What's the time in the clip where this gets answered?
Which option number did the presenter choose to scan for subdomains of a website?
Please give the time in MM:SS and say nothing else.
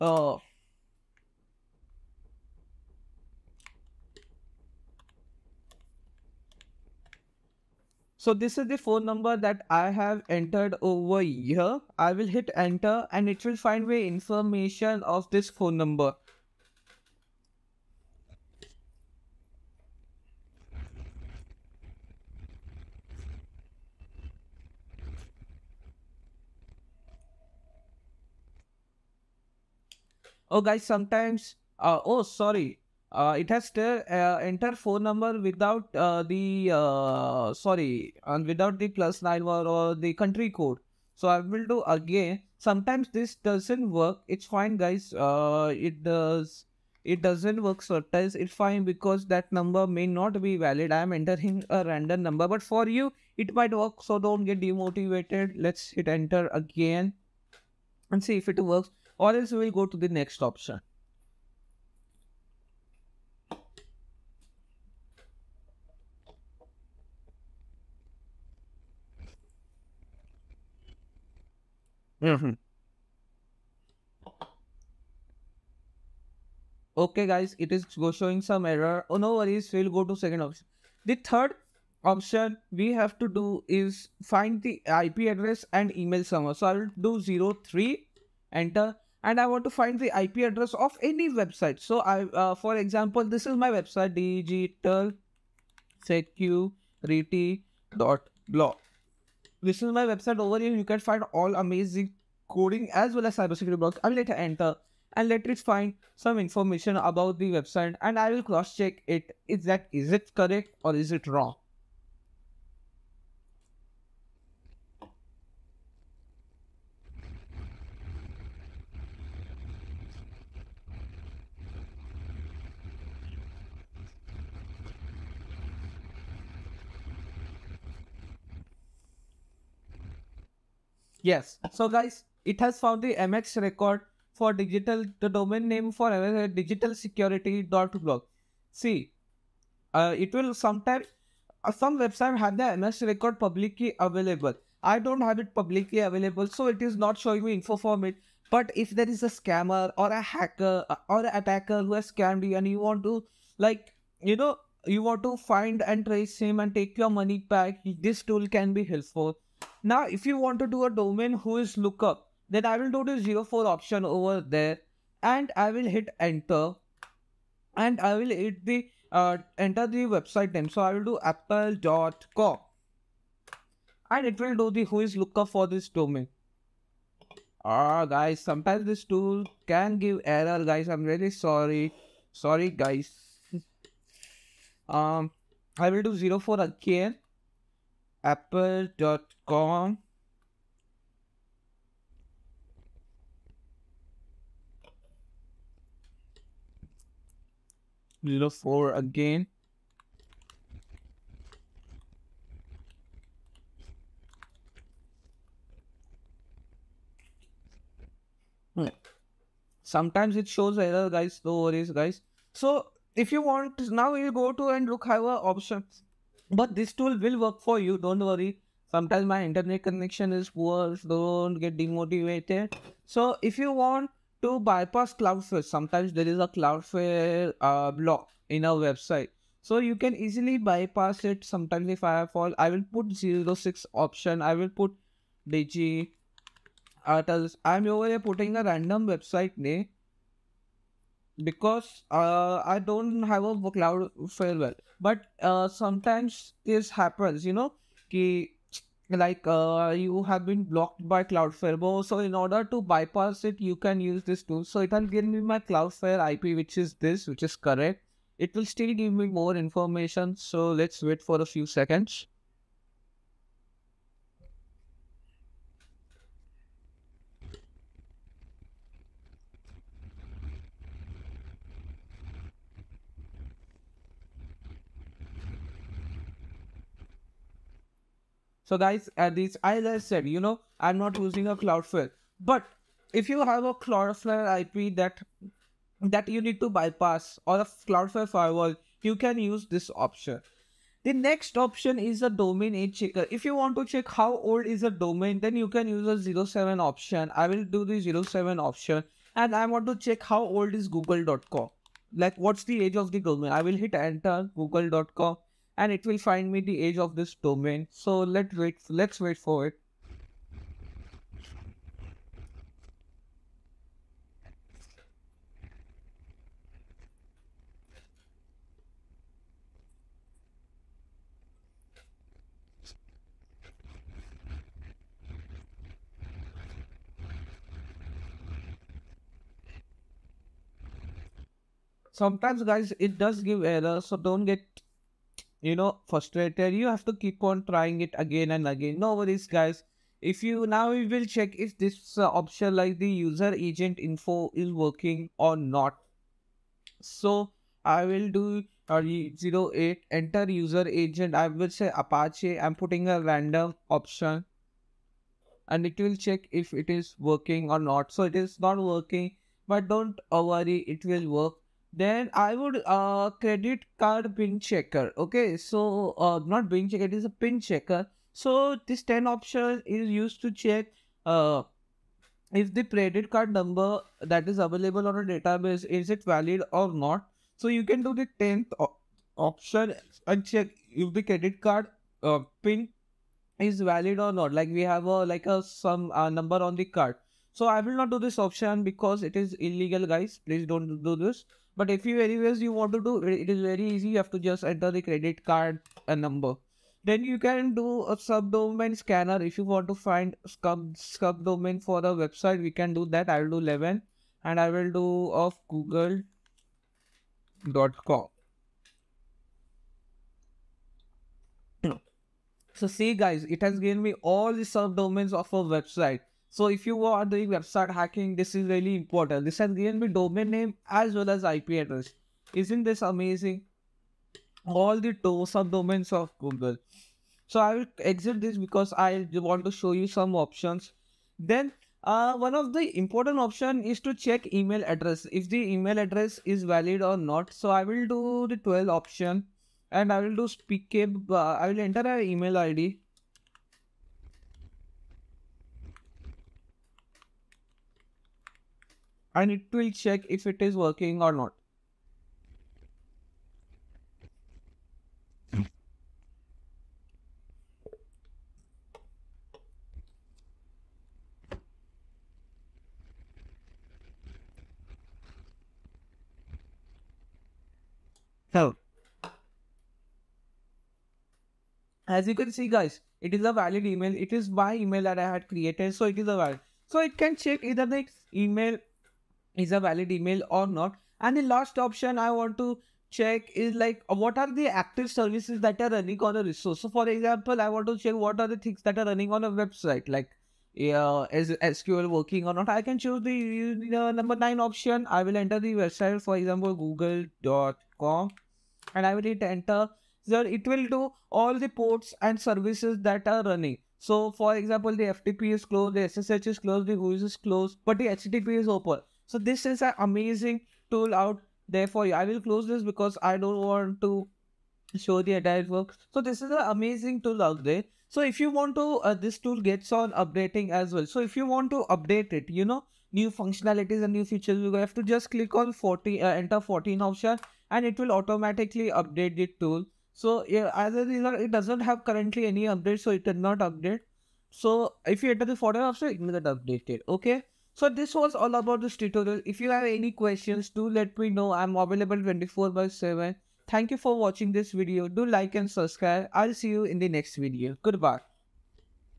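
06:43.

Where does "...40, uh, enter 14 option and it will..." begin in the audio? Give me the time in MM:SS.
08:45.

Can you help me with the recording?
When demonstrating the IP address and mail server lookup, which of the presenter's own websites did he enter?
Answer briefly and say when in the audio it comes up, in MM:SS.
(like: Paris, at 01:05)
digitalsecurity.blog, at 01:36.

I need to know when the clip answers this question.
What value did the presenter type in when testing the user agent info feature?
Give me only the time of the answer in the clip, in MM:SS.
05:51.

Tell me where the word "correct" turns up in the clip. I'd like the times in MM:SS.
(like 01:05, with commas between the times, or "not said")
01:50, 04:17.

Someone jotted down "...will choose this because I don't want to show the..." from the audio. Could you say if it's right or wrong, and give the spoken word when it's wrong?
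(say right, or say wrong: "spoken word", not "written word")
wrong: "close", not "choose".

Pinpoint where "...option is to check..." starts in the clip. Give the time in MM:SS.
07:13.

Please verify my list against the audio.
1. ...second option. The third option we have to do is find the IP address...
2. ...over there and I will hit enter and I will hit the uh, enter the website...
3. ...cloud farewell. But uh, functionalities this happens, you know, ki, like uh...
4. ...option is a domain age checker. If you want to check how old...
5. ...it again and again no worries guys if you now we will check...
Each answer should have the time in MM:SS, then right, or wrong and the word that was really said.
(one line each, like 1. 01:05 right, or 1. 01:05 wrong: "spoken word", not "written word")
1. 01:20 right
2. 02:44 right
3. 04:03 wrong: "sometimes", not "functionalities"
4. 04:51 right
5. 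05:38 right.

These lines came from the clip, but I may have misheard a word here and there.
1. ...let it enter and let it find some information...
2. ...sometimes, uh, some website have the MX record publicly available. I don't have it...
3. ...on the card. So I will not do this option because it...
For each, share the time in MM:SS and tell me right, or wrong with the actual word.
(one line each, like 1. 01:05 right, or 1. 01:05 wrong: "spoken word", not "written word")
1. 01:44 right
2. 02:20 right
3. 06:26 right.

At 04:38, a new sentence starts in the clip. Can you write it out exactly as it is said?
So guys, at least I said, you know, I'm not using a Cloudflare.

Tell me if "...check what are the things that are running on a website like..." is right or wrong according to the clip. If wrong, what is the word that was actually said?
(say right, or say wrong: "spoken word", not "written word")
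right.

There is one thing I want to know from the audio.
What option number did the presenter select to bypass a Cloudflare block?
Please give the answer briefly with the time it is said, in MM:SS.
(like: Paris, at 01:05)
6, at 03:53.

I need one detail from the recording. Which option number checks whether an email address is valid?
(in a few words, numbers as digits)
12.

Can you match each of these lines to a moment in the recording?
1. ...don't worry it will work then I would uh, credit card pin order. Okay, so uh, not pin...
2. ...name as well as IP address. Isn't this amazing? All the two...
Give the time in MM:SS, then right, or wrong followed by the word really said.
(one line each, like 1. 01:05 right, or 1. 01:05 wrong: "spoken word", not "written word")
1. 05:59 wrong: "checker", not "order"
2. 07:00 right.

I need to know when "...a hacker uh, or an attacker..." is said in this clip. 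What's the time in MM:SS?
02:30.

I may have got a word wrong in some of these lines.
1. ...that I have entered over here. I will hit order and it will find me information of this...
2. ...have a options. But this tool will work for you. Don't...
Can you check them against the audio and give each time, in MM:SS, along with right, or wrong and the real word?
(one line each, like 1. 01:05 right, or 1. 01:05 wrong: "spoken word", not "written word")
1. 00:09 wrong: "enter", not "order"
2. 03:35 right.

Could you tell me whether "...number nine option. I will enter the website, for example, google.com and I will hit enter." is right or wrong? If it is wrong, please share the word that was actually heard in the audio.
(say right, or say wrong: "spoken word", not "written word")
right.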